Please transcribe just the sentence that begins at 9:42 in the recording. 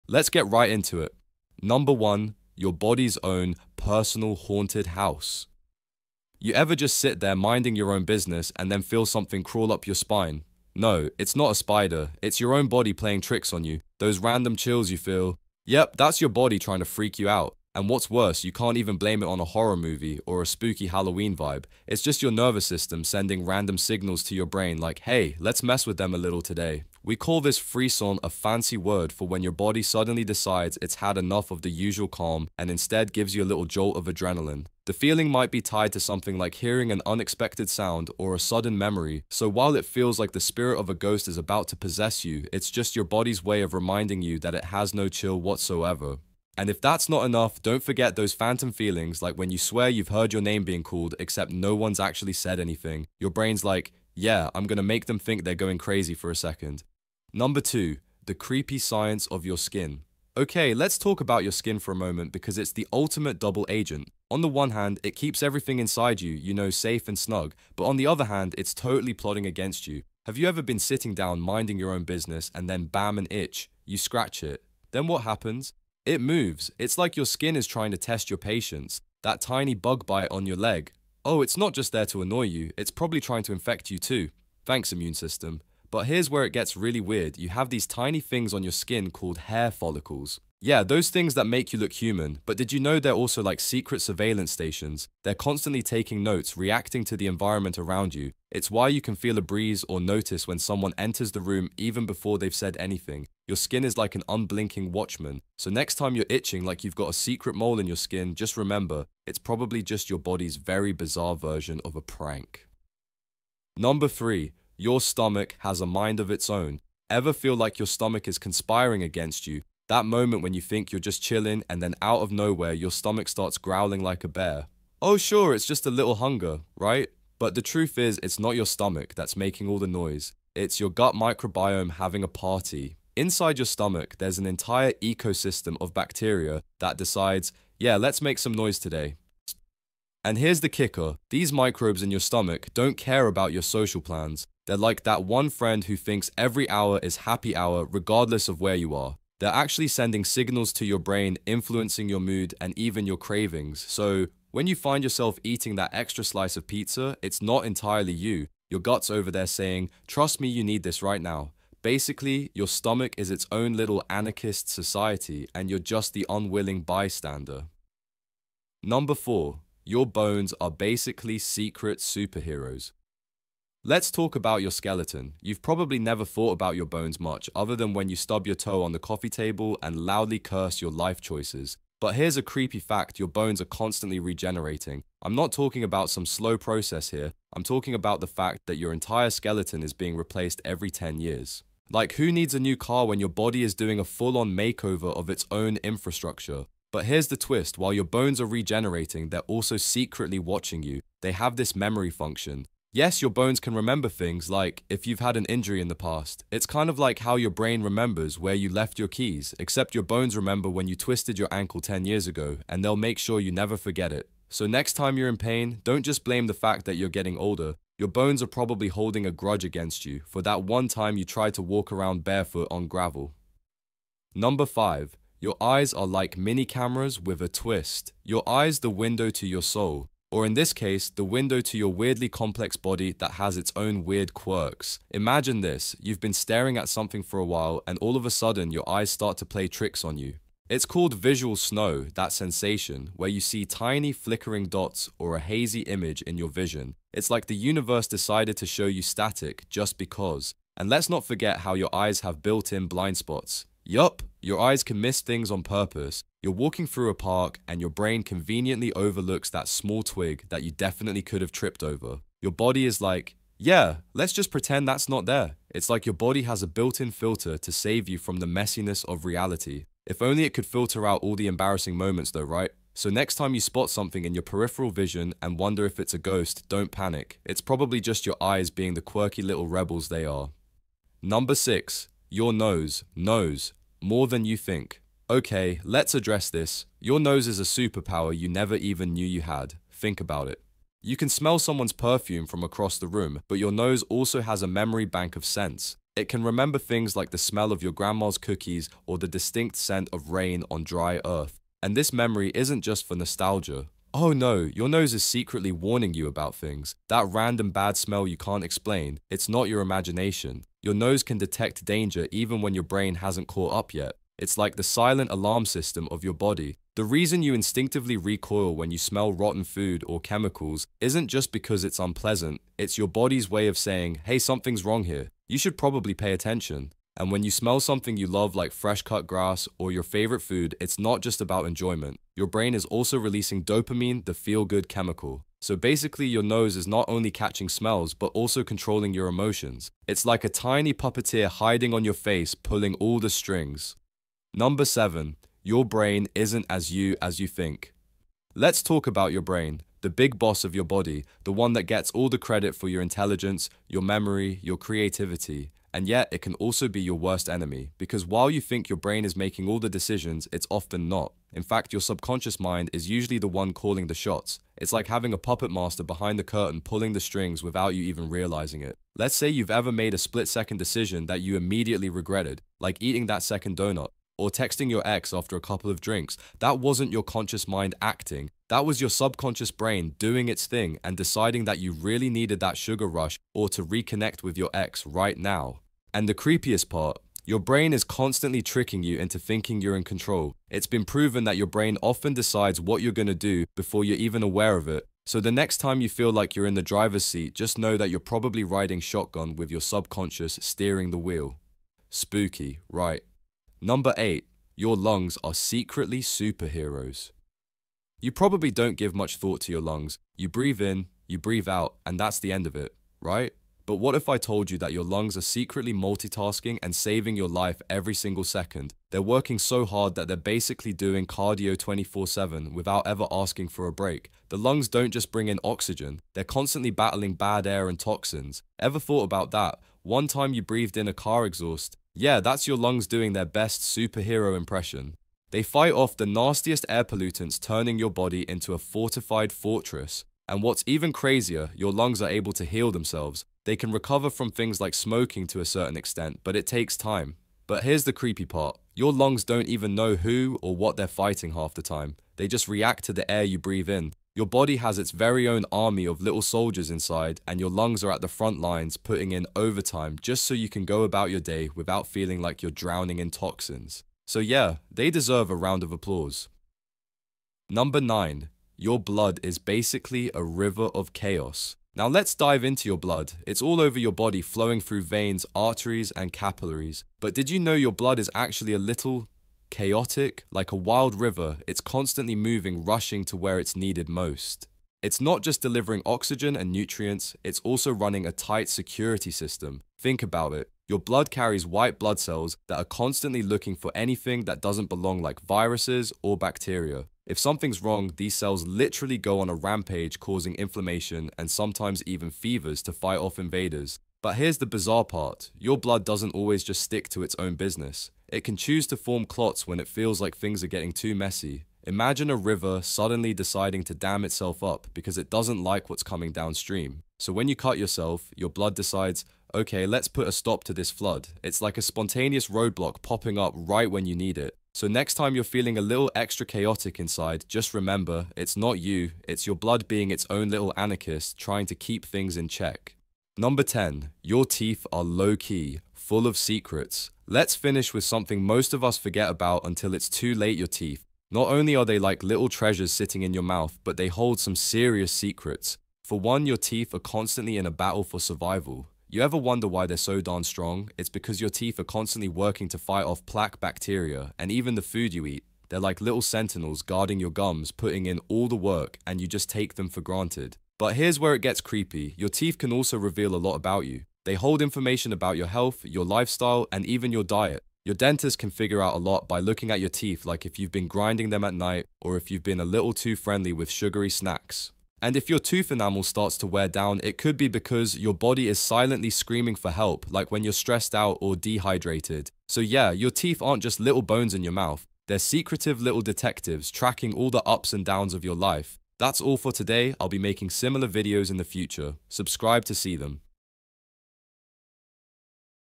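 So yeah, your teeth aren't just little bones in your mouth.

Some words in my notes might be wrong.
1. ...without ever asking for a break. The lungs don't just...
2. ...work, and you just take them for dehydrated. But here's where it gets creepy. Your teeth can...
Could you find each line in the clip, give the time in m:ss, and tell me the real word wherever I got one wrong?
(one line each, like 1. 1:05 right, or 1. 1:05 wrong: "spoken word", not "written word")
1. 7:02 right
2. 9:18 wrong: "granted", not "dehydrated".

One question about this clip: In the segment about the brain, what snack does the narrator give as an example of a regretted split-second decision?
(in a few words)
second donut.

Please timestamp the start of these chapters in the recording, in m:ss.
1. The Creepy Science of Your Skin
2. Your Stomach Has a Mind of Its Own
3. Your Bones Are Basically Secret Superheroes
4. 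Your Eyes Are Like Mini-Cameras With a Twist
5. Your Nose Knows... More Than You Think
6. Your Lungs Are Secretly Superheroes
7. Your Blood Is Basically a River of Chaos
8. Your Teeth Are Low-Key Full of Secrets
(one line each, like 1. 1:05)
1. 0:57
2. 1:53
3. 2:48
4. 3:44
5. 4:41
6. 6:43
7. 7:47
8. 8:53.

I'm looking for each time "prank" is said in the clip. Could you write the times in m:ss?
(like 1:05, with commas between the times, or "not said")
1:52.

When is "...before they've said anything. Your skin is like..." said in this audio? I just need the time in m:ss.
1:42.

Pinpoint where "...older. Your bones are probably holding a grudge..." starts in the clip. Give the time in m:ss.
3:37.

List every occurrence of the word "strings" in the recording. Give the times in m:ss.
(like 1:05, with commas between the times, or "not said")
5:43, 6:07.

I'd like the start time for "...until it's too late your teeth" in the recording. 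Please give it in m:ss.
8:59.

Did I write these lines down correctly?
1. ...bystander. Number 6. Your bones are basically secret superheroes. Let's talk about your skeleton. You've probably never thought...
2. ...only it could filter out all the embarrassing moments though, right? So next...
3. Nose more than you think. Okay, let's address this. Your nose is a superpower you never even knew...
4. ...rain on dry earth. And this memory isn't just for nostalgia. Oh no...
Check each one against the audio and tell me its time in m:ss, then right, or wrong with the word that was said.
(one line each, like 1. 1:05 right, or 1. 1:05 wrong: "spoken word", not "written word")
1. 2:46 wrong: "4", not "6"
2. 4:30 right
3. 4:43 right
4. 5:00 right.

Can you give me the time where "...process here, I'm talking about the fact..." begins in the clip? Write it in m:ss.
3:06.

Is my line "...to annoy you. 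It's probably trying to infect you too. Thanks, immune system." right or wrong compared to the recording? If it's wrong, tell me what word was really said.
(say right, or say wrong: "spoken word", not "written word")
right.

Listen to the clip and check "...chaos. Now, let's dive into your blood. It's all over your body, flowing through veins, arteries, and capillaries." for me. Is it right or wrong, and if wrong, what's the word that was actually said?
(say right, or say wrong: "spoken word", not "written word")
right.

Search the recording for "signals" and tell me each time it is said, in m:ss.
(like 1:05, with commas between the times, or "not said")
0:23, 2:30.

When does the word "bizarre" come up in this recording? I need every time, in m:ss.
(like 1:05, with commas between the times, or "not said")
1:50, 8:24.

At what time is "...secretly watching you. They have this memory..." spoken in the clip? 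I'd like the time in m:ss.
3:19.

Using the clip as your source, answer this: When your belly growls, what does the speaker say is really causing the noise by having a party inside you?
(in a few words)
gut microbiome.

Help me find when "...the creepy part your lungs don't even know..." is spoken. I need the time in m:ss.
7:28.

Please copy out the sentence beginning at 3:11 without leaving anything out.
Like, who needs a new car when your body is doing a full on makeover of its own infrastructure?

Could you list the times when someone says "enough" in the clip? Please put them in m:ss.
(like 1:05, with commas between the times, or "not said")
0:31, 0:47.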